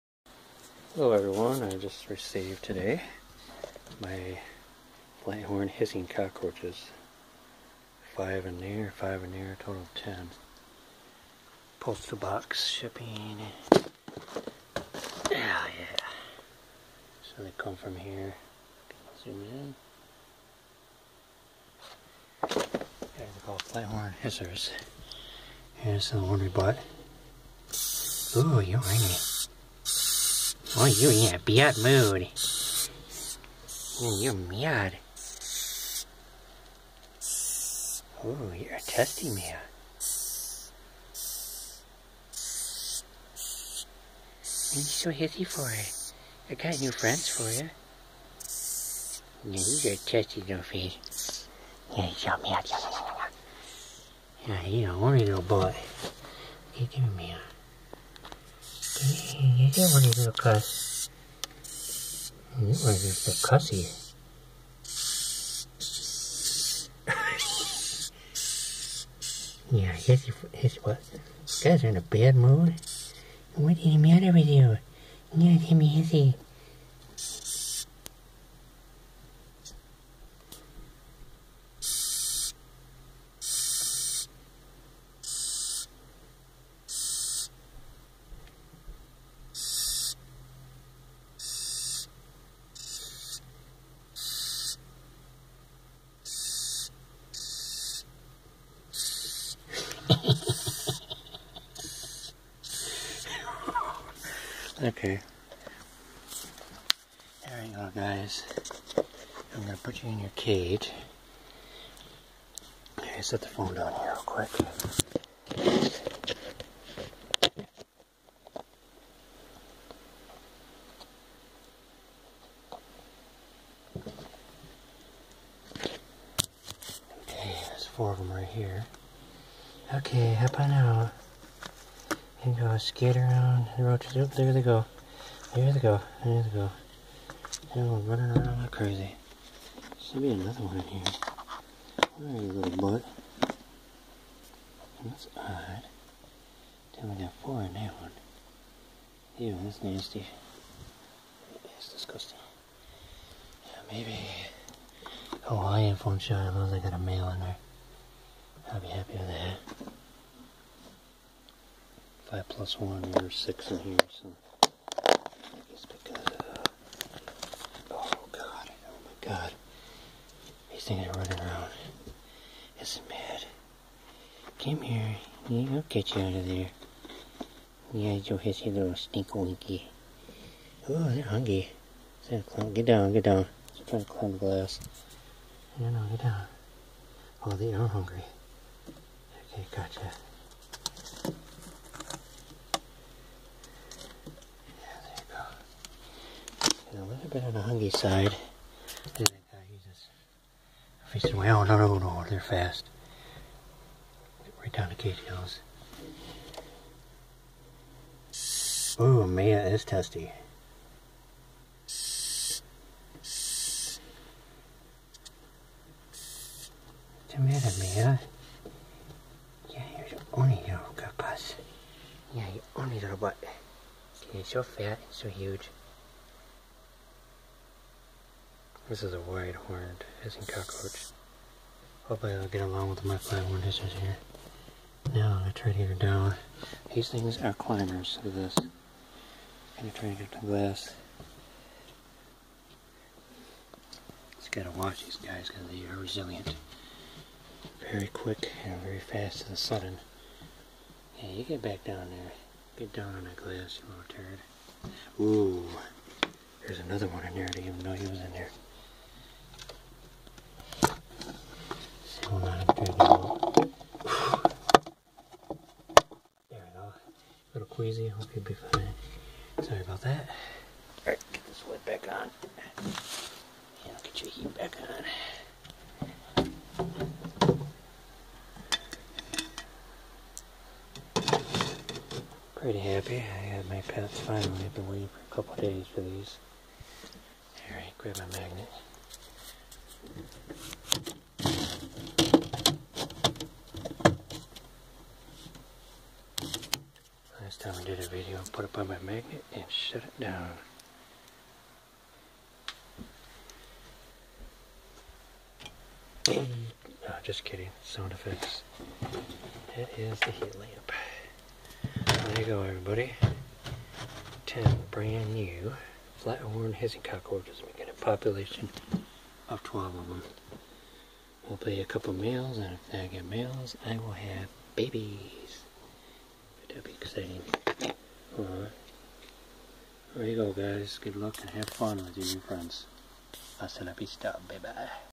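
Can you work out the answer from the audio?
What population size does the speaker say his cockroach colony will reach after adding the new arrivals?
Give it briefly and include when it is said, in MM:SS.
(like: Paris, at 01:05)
12, at 05:19.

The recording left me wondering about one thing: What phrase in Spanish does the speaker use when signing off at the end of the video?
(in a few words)
Hasta la vista.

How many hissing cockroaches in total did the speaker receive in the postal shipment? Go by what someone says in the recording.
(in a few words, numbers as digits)
10.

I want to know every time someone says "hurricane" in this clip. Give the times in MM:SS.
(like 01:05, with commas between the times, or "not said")
not said.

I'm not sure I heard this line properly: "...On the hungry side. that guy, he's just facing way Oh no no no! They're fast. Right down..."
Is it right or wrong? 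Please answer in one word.
right.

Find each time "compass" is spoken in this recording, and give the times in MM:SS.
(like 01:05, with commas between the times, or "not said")
not said.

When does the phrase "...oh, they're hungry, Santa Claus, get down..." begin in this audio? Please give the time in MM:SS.
03:00.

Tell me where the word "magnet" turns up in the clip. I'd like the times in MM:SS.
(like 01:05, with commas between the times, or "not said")
04:48, 04:59.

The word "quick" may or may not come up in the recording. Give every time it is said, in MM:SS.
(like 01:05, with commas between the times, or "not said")
01:54, 04:08.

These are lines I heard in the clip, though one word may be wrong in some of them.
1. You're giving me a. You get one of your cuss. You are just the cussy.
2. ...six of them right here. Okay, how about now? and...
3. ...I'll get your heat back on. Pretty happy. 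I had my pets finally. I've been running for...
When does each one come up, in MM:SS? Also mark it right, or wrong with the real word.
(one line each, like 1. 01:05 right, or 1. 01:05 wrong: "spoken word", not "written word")
1. 00:56 right
2. 02:07 wrong: "four", not "six"
3. 04:33 wrong: "waiting", not "running".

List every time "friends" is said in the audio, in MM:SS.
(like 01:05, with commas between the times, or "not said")
00:46, 05:32.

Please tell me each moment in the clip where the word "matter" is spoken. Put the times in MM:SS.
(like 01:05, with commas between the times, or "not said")
01:13, 03:37.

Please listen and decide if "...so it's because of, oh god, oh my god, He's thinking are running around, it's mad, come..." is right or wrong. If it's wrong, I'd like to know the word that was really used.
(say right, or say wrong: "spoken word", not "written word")
right.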